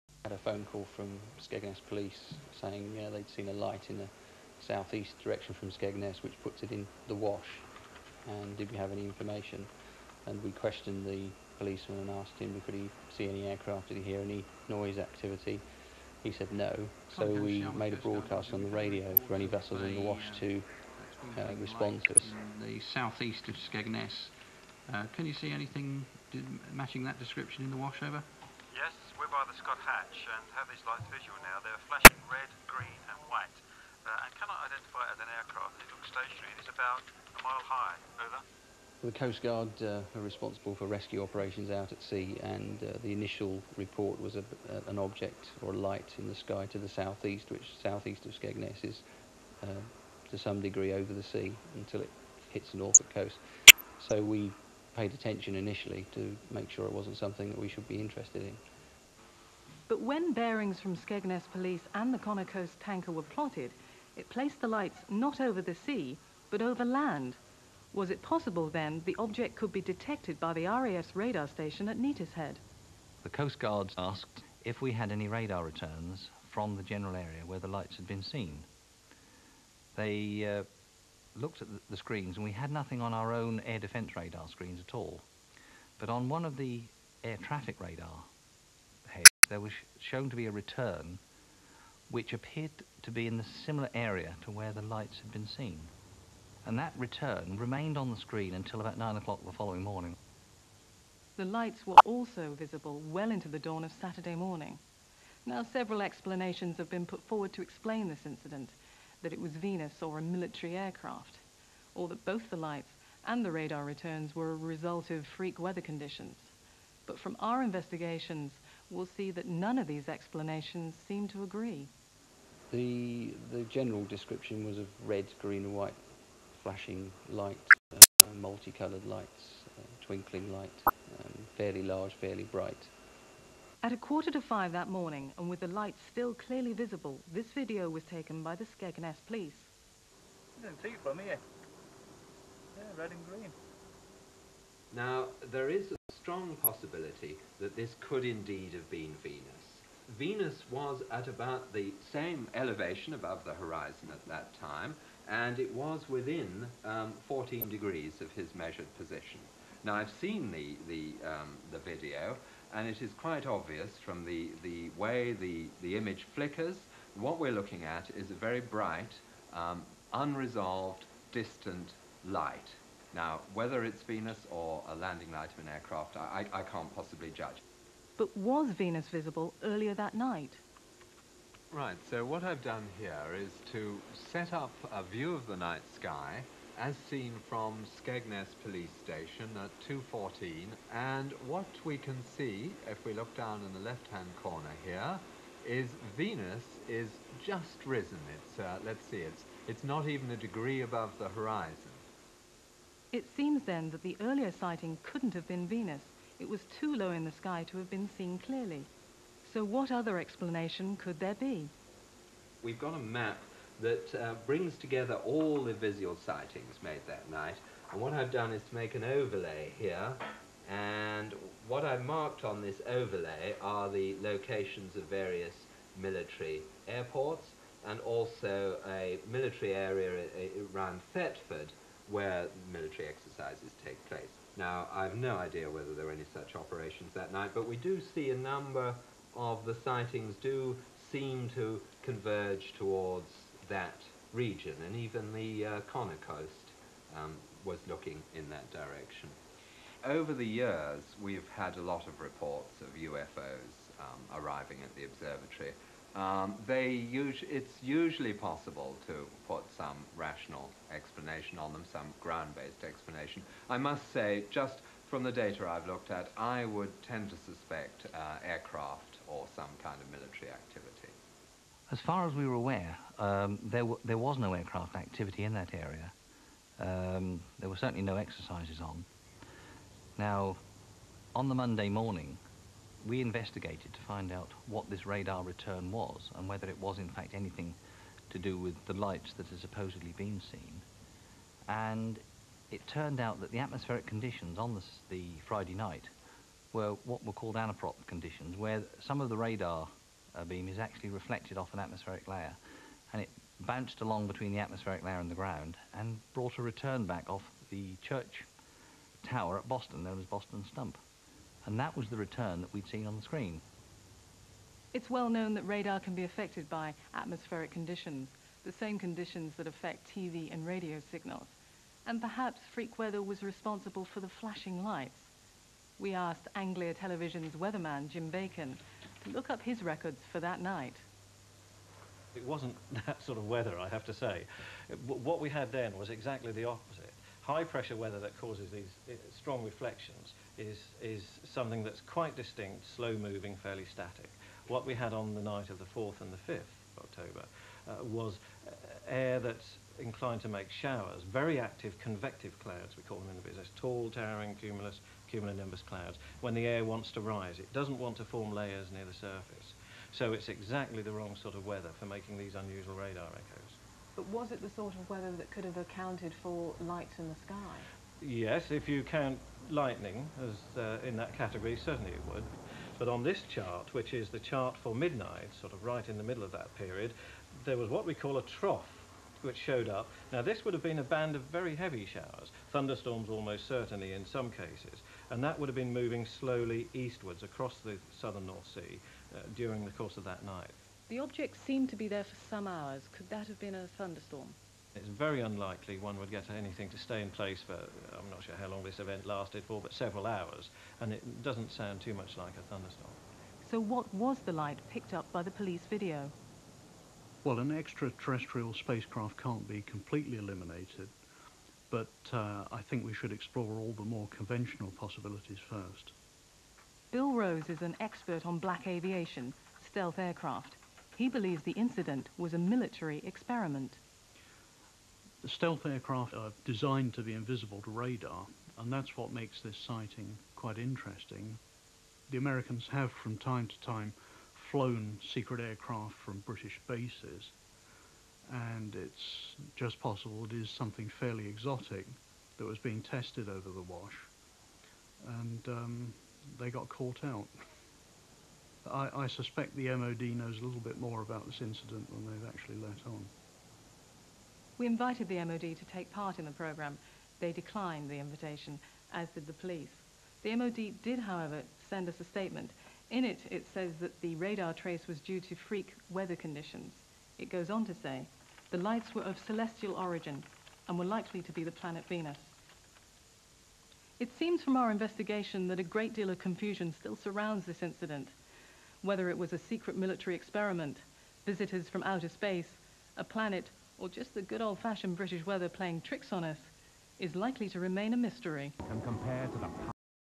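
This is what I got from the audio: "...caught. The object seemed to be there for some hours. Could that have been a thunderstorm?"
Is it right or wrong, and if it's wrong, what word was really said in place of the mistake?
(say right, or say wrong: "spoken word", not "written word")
wrong: "night", not "caught".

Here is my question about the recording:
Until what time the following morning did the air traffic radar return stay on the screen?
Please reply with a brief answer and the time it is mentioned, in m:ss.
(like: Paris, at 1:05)
9 o'clock, at 1:38.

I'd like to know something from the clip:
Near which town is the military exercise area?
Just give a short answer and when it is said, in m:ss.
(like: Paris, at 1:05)
Thetford, at 3:51.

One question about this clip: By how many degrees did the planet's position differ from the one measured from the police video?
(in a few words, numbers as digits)
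14.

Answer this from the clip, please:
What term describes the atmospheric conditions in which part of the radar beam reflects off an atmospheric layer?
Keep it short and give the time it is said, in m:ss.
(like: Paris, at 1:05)
anaprop, at 4:57.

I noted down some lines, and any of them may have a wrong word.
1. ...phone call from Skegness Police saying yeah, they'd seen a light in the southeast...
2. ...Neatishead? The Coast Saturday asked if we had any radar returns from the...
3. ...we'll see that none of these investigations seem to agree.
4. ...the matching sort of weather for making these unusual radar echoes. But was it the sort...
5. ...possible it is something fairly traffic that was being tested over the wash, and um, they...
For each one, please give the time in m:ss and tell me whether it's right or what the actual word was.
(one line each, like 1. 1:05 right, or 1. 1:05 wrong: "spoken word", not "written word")
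1. 0:00 right
2. 1:11 wrong: "Guards", not "Saturday"
3. 1:58 wrong: "explanations", not "investigations"
4. 6:01 wrong: "wrong", not "matching"
5. 7:19 wrong: "exotic", not "traffic".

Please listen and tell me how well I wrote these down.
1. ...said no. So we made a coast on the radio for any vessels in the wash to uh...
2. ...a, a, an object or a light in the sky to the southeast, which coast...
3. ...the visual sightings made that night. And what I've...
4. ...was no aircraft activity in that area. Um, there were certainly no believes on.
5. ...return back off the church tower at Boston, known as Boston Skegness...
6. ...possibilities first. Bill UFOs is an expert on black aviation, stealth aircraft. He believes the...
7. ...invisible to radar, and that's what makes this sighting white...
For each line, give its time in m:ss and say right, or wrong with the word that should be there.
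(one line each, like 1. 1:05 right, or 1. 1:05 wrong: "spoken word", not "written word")
1. 0:16 wrong: "broadcast", not "coast"
2. 0:44 wrong: "southeast", not "coast"
3. 3:35 right
4. 4:34 wrong: "exercises", not "believes"
5. 5:06 wrong: "Stump", not "Skegness"
6. 6:54 wrong: "Rose", not "UFOs"
7. 7:07 wrong: "quite", not "white".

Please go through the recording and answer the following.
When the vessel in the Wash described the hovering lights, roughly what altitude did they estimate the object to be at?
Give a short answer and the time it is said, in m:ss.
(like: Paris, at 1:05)
about a mile high, at 0:36.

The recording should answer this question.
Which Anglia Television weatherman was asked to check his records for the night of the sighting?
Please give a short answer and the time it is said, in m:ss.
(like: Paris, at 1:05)
Jim Bacon, at 5:28.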